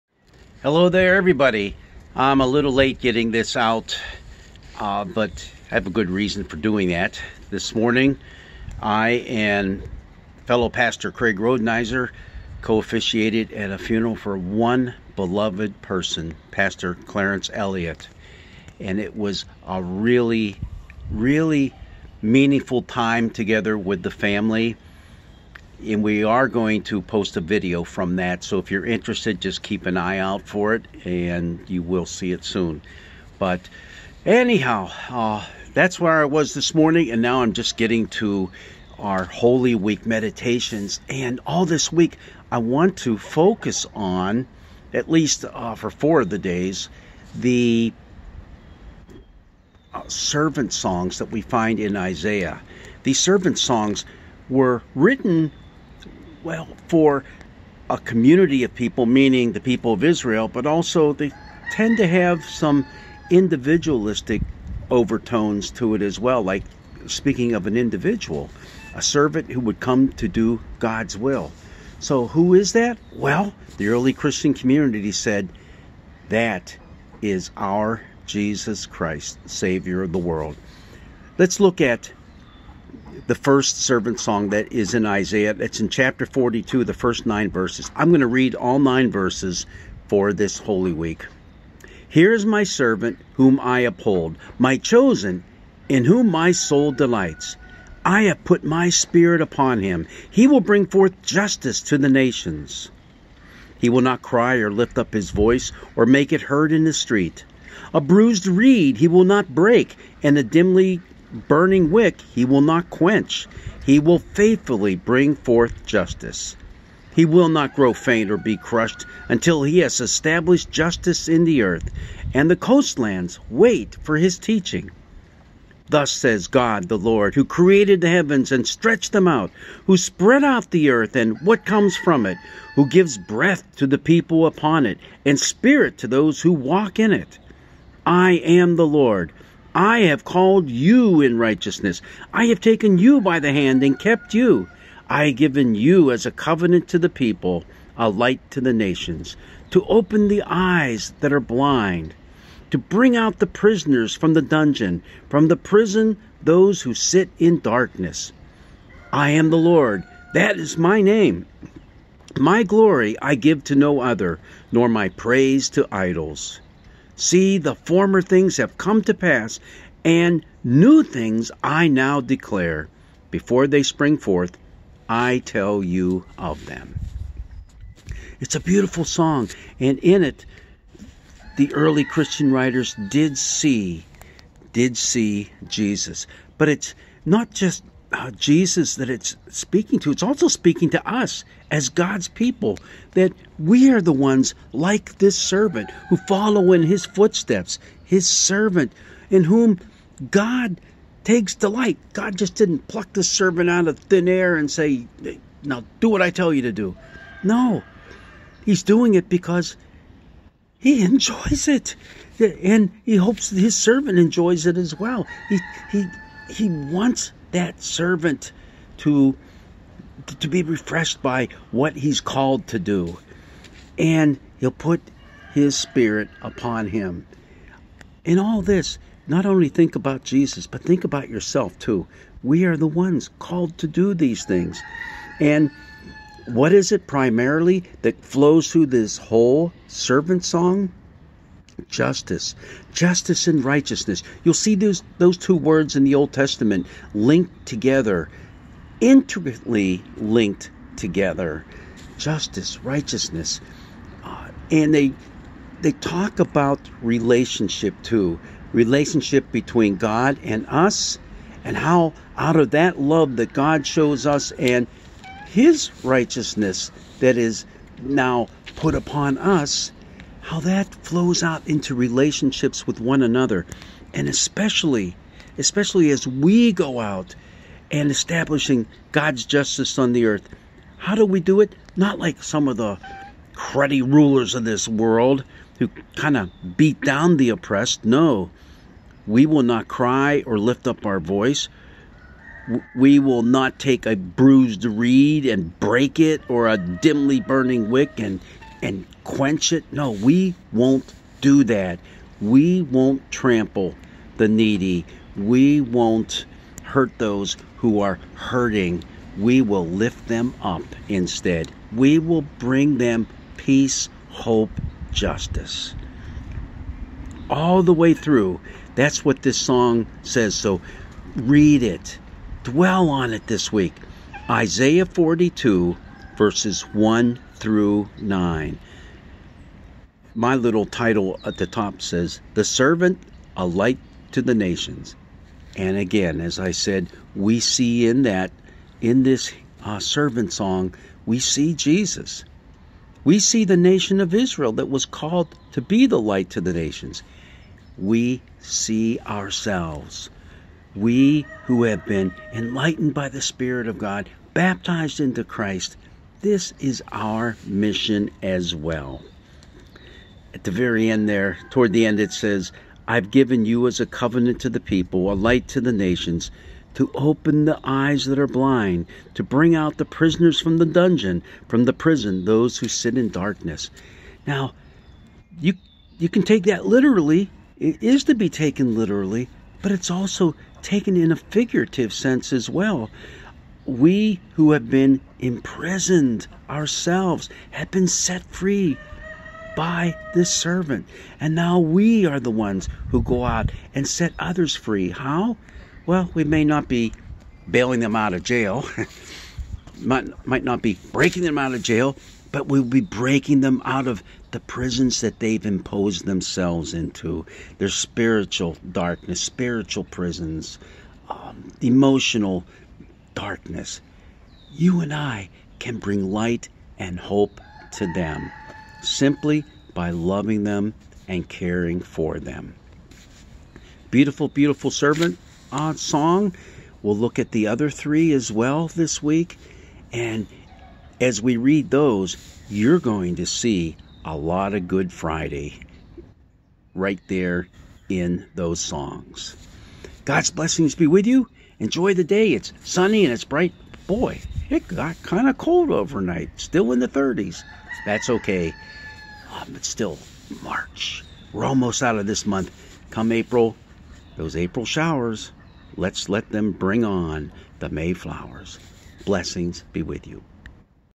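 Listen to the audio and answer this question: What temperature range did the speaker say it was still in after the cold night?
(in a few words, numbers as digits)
the 30s.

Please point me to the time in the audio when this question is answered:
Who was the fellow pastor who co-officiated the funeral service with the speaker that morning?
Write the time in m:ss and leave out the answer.
0:11.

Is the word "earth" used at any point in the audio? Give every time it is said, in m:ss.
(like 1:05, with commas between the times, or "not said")
2:01, 2:10, 4:40.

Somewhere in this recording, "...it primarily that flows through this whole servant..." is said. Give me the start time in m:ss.
3:56.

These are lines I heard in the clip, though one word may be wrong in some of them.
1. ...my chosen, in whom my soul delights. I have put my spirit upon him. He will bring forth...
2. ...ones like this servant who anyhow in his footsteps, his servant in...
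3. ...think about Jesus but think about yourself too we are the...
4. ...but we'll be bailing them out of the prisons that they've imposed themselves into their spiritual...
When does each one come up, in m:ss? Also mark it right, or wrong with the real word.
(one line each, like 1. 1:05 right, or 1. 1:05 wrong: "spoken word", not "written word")
1. 1:34 right
2. 3:14 wrong: "follow", not "anyhow"
3. 3:49 right
4. 6:42 wrong: "breaking", not "bailing".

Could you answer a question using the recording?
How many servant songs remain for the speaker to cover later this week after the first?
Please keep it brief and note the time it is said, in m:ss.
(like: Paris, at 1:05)
3, at 7:07.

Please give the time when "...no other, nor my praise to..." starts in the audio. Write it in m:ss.
2:43.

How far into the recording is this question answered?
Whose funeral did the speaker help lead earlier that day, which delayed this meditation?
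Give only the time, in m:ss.
0:16.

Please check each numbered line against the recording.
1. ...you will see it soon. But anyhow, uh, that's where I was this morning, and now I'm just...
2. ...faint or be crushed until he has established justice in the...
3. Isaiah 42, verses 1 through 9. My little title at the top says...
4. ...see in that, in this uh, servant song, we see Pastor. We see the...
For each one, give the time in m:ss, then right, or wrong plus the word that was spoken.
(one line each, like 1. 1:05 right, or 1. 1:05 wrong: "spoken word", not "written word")
1. 0:31 right
2. 1:57 right
3. 5:24 right
4. 5:37 wrong: "Jesus", not "Pastor".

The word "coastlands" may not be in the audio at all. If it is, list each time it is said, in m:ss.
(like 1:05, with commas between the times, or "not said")
2:02.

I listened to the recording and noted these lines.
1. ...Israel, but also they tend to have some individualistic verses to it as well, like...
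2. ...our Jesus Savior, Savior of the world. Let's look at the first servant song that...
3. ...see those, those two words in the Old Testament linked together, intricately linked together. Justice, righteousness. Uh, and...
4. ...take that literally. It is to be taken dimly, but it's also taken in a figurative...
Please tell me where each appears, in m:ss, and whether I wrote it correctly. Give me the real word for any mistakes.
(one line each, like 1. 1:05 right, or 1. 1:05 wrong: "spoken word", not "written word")
1. 1:00 wrong: "overtones", not "verses"
2. 1:17 wrong: "Christ", not "Savior"
3. 4:04 right
4. 6:16 wrong: "literally", not "dimly".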